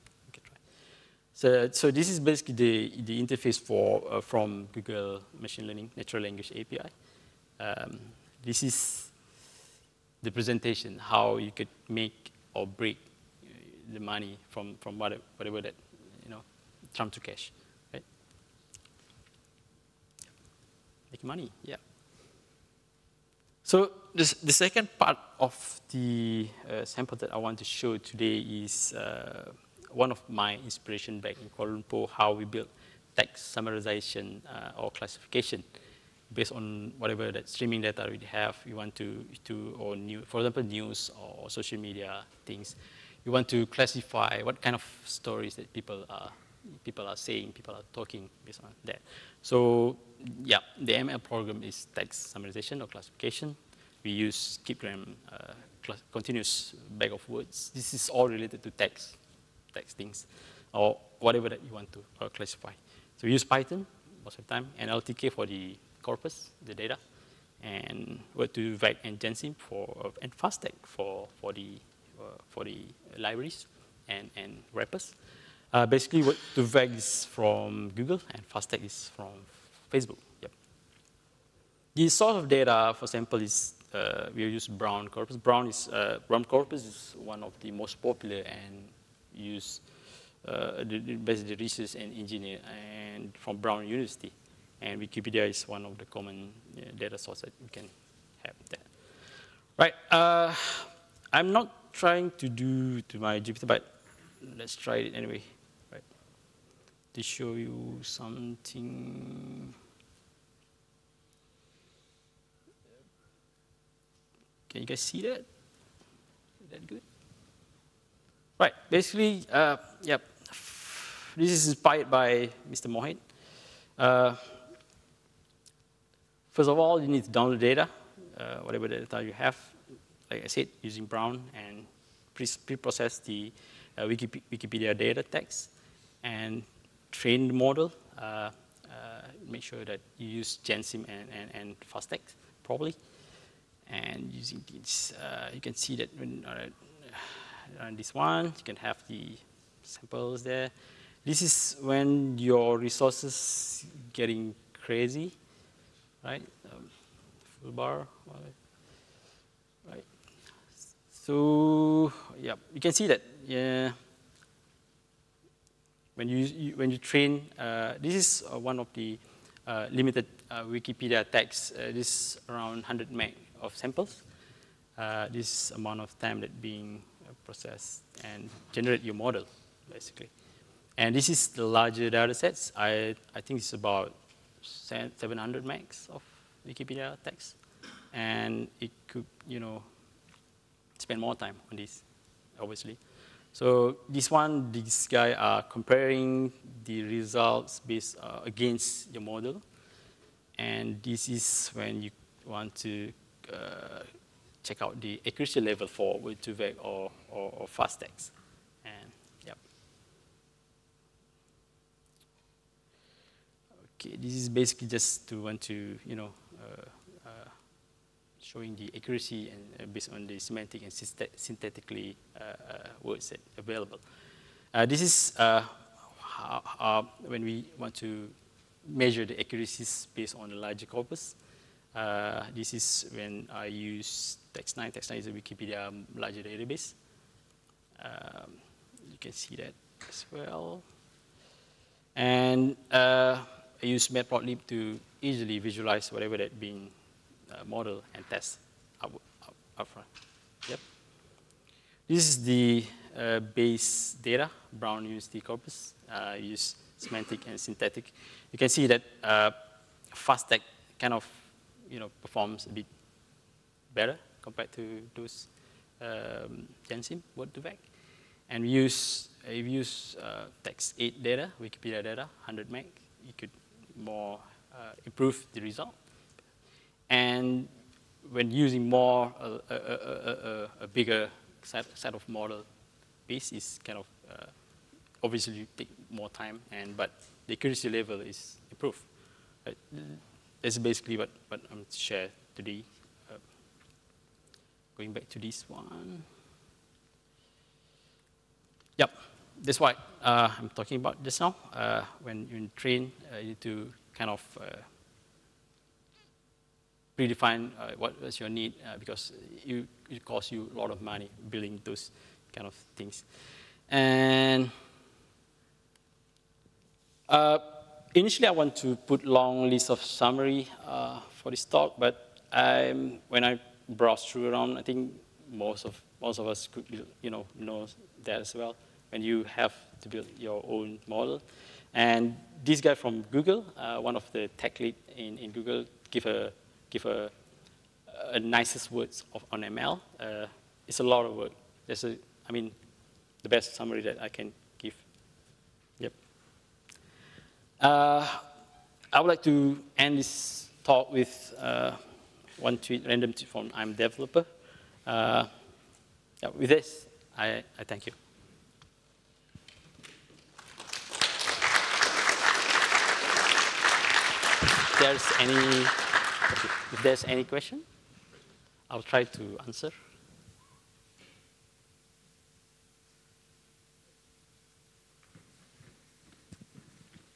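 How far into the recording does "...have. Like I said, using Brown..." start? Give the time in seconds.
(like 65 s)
129 s.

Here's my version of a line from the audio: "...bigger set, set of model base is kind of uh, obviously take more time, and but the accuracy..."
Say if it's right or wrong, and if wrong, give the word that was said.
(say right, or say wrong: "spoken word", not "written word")
right.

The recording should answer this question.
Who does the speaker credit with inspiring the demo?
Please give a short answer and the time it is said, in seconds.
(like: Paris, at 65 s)
Mr. Mohit, at 122 s.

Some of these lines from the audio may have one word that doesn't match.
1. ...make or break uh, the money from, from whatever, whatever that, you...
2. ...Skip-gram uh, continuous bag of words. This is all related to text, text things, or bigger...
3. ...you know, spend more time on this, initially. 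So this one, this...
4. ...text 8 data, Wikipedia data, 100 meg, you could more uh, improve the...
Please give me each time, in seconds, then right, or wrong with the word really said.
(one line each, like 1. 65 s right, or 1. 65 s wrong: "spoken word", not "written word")
1. 11 s right
2. 54 s wrong: "whatever", not "bigger"
3. 189 s wrong: "obviously", not "initially"
4. 270 s right.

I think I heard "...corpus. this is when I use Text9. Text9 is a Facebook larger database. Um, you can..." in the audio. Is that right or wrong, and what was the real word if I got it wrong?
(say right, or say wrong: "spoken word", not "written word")
wrong: "Wikipedia", not "Facebook".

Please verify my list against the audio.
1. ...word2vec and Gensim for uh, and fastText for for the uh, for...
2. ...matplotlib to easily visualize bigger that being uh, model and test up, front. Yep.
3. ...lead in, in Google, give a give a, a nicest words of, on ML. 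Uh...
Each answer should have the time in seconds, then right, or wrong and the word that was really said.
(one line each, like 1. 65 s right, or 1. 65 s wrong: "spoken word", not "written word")
1. 68 s right
2. 244 s wrong: "whatever", not "bigger"
3. 334 s right.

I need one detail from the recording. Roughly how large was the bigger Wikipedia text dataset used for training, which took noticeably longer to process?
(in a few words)
700 megs.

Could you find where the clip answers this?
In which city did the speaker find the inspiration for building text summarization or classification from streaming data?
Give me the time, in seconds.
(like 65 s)
31 s.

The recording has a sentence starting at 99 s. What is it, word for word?
Right, uh, I'm not trying to do to my GPT, but let's try it anyway to show you something.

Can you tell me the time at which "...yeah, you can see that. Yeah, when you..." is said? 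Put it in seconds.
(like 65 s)
162 s.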